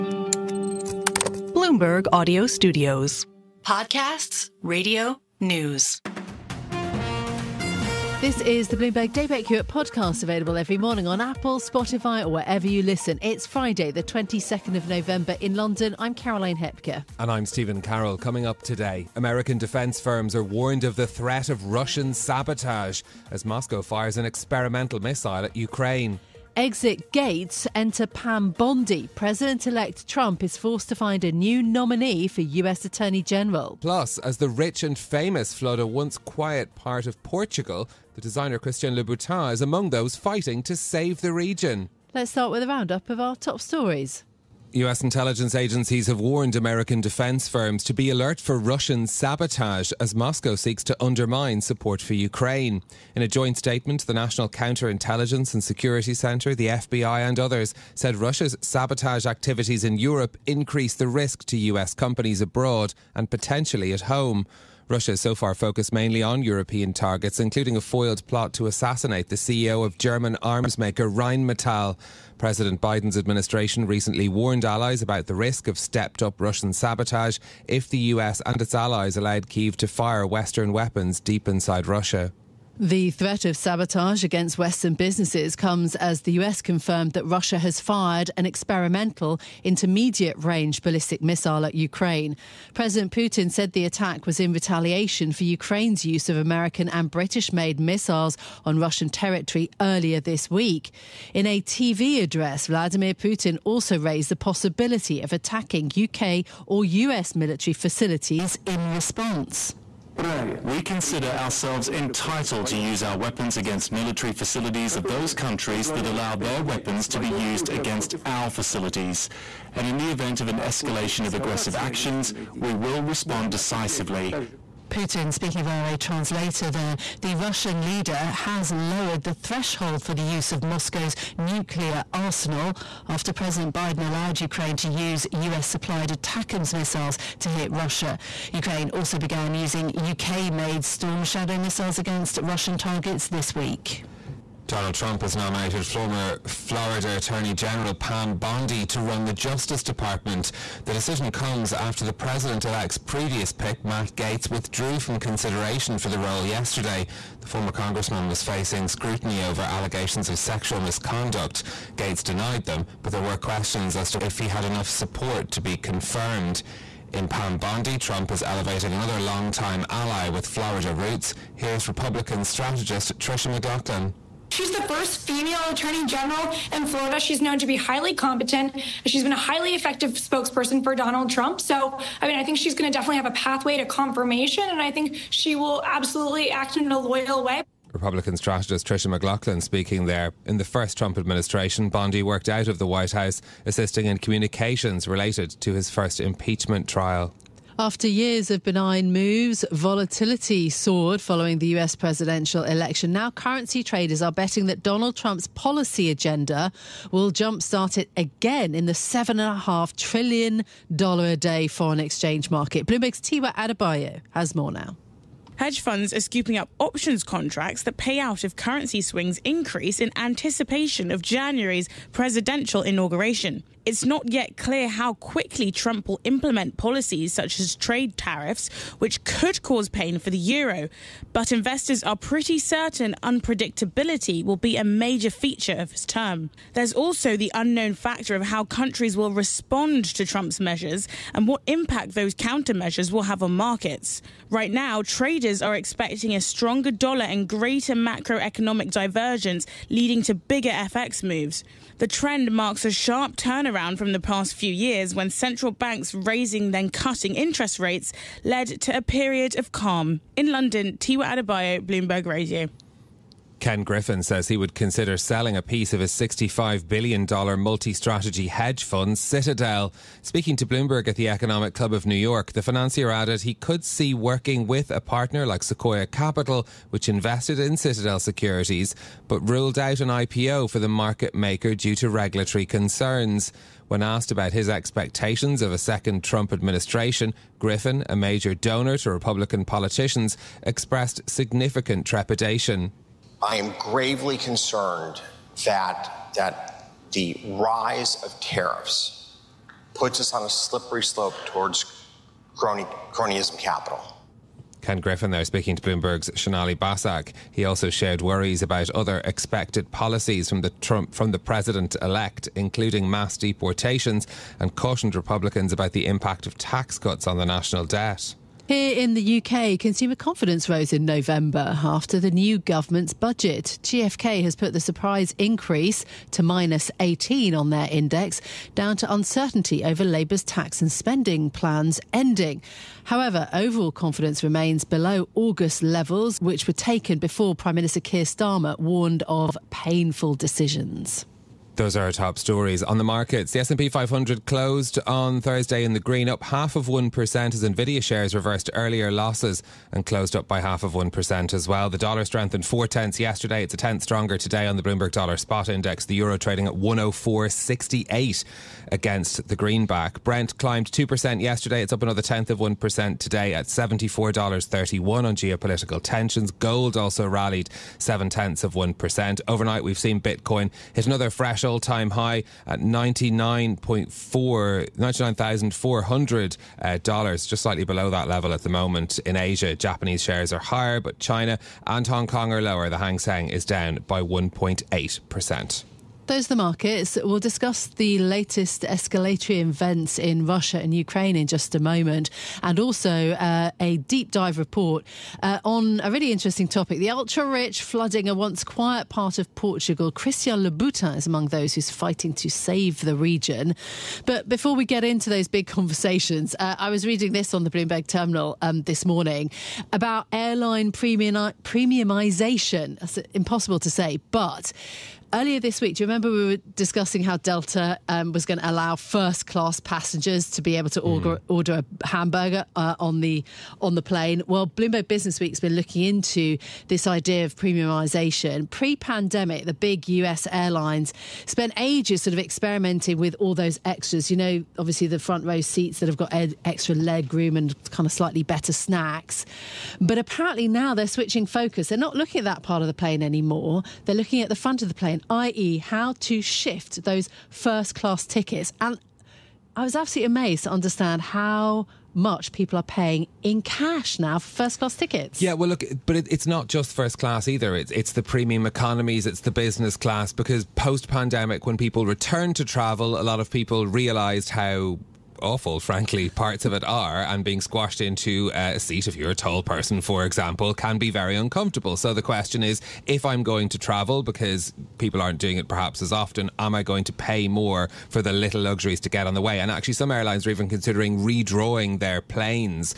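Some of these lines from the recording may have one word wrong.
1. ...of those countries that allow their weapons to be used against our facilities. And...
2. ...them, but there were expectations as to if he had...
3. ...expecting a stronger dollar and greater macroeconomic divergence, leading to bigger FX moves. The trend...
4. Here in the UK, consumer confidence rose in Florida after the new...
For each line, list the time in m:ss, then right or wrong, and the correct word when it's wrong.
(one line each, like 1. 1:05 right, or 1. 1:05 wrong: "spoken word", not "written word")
1. 1:54 right
2. 2:42 wrong: "questions", not "expectations"
3. 4:05 right
4. 5:18 wrong: "November", not "Florida".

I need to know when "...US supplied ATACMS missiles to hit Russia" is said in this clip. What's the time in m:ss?
2:15.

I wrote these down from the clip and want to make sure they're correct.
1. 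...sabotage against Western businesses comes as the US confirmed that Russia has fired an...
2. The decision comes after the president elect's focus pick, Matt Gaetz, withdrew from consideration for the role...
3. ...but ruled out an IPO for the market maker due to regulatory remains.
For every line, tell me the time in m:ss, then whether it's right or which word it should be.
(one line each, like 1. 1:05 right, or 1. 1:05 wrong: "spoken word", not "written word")
1. 1:23 right
2. 2:30 wrong: "previous", not "focus"
3. 4:39 wrong: "concerns", not "remains".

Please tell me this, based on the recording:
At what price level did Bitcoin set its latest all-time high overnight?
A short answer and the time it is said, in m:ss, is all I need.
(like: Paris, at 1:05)
$99,400, at 6:12.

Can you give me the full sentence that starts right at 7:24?
They're looking at the front of the plane i.e., how to shift those first class tickets.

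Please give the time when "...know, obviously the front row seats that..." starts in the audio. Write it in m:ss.
7:14.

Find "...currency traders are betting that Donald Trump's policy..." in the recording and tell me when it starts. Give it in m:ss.
3:23.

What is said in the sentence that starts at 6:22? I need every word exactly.
The Hang Seng is down by 1.8% those are the markets.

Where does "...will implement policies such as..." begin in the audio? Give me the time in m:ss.
3:46.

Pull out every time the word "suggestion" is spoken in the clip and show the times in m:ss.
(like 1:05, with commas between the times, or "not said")
not said.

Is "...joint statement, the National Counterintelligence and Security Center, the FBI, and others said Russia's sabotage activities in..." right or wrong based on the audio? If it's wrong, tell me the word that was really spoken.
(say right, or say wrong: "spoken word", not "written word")
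right.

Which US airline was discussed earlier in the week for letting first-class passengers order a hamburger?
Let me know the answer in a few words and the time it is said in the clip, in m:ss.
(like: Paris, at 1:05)
Delta, at 6:57.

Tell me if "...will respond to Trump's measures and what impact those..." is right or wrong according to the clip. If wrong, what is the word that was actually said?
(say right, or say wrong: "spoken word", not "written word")
right.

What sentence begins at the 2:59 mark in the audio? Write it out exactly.
She's been a highly effective spokesperson for Donald Trump.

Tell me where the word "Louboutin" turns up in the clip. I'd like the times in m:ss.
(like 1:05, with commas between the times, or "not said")
0:38, 6:40.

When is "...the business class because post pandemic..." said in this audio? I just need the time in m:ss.
7:39.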